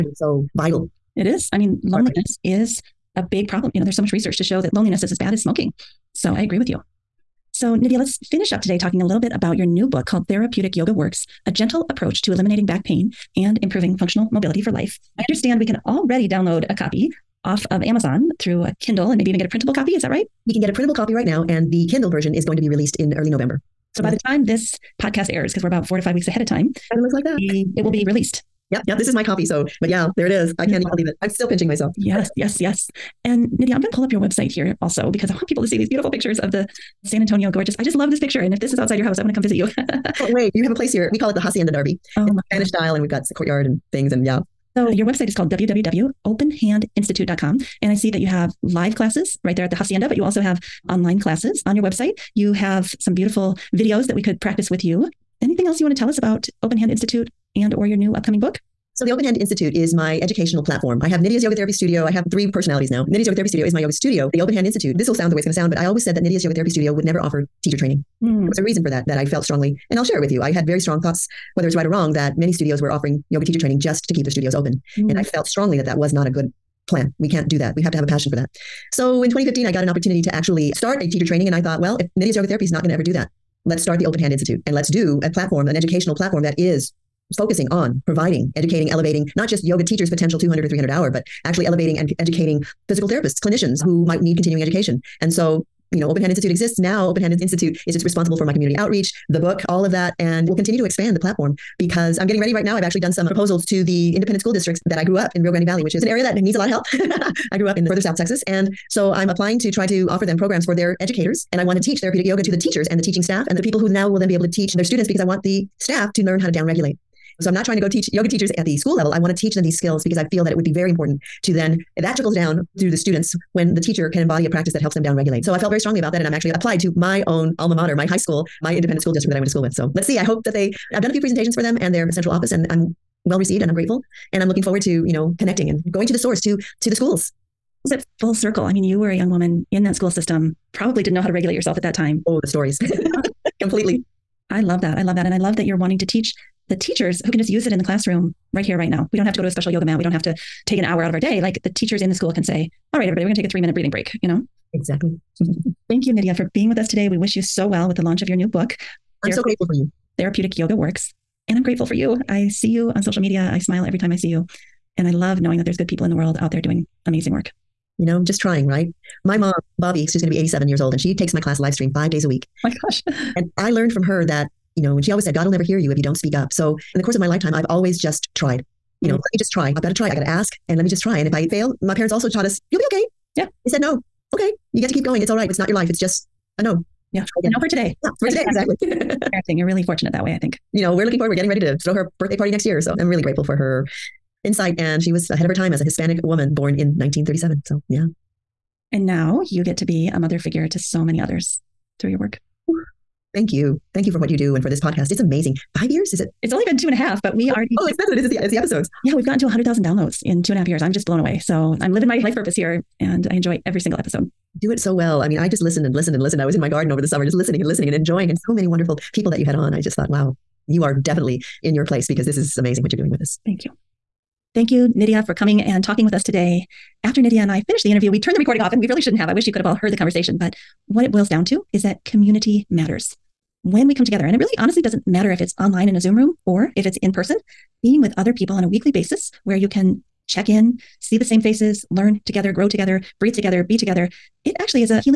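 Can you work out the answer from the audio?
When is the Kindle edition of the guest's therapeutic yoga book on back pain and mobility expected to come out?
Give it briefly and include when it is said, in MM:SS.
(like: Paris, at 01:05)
early November, at 00:23.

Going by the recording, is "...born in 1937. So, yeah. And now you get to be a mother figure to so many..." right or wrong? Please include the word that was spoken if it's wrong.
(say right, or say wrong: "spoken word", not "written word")
right.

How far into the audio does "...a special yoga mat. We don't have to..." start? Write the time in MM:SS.
02:29.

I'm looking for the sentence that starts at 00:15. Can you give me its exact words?
I understand we can already download a copy off of Amazon through a Kindle and maybe even get a printable copy.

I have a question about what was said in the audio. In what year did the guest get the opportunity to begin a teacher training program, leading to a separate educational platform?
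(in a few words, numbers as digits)
2015.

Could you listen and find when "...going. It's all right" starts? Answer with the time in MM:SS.
03:05.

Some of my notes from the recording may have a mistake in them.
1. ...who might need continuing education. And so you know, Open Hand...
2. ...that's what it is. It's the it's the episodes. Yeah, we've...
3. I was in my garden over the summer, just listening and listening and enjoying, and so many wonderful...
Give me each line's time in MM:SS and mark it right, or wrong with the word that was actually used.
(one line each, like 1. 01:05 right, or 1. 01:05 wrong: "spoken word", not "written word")
1. 01:33 right
2. 03:27 right
3. 03:36 right.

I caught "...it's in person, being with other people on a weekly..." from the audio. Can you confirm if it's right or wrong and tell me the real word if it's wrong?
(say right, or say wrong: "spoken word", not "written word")
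right.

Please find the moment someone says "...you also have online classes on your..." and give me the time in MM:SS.
00:50.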